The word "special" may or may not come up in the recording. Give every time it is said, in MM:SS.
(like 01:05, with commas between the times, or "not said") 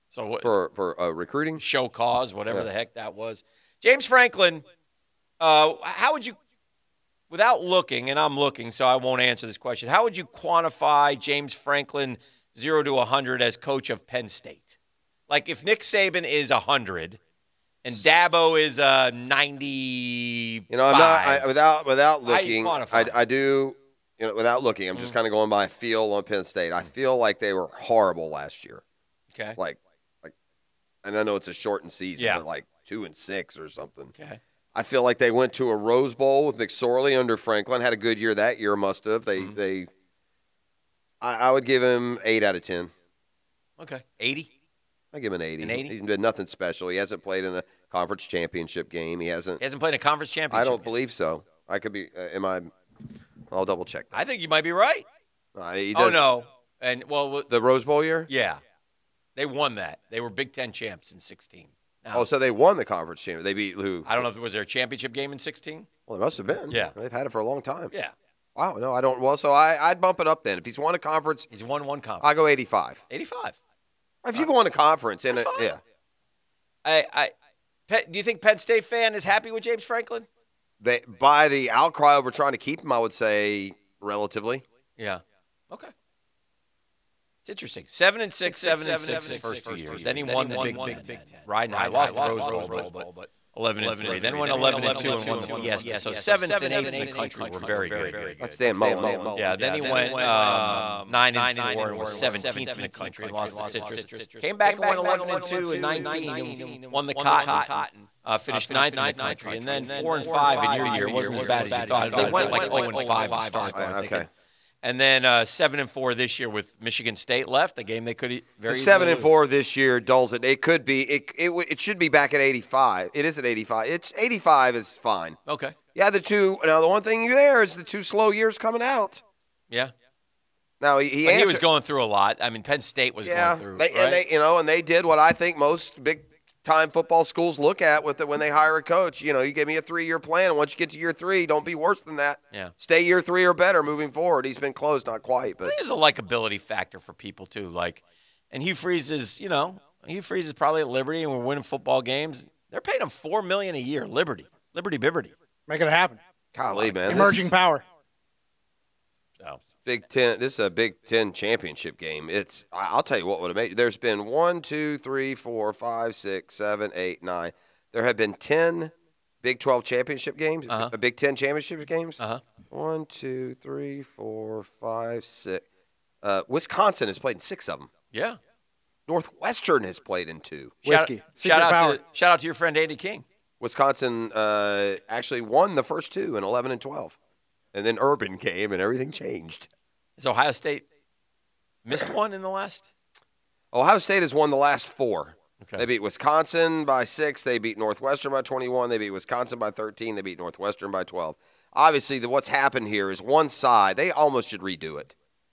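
00:46.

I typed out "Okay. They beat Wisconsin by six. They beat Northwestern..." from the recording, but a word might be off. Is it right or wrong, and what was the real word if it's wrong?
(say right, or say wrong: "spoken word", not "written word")
right.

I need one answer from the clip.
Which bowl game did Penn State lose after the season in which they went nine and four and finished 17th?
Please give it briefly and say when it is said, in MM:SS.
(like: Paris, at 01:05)
Citrus, at 01:43.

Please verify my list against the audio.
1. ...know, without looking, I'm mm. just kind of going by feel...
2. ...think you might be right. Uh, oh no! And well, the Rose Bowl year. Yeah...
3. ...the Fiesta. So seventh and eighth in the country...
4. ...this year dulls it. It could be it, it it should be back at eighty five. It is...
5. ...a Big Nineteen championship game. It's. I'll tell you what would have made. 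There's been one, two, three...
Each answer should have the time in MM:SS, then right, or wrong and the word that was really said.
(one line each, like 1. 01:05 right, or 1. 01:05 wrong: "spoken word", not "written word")
1. 00:24 right
2. 00:54 right
3. 01:35 right
4. 01:59 right
5. 02:40 wrong: "Ten", not "Nineteen".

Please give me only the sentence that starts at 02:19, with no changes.
You know, you give me a three year plan, and once you get to year three, don't be worse than that.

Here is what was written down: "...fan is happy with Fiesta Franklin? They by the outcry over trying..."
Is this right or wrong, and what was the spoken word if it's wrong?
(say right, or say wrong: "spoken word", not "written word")
wrong: "James", not "Fiesta".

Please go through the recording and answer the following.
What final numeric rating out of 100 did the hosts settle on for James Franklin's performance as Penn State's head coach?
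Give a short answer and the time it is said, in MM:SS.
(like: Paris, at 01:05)
85, at 01:12.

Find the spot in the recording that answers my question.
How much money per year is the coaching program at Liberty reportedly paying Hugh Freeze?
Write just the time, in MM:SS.
02:33.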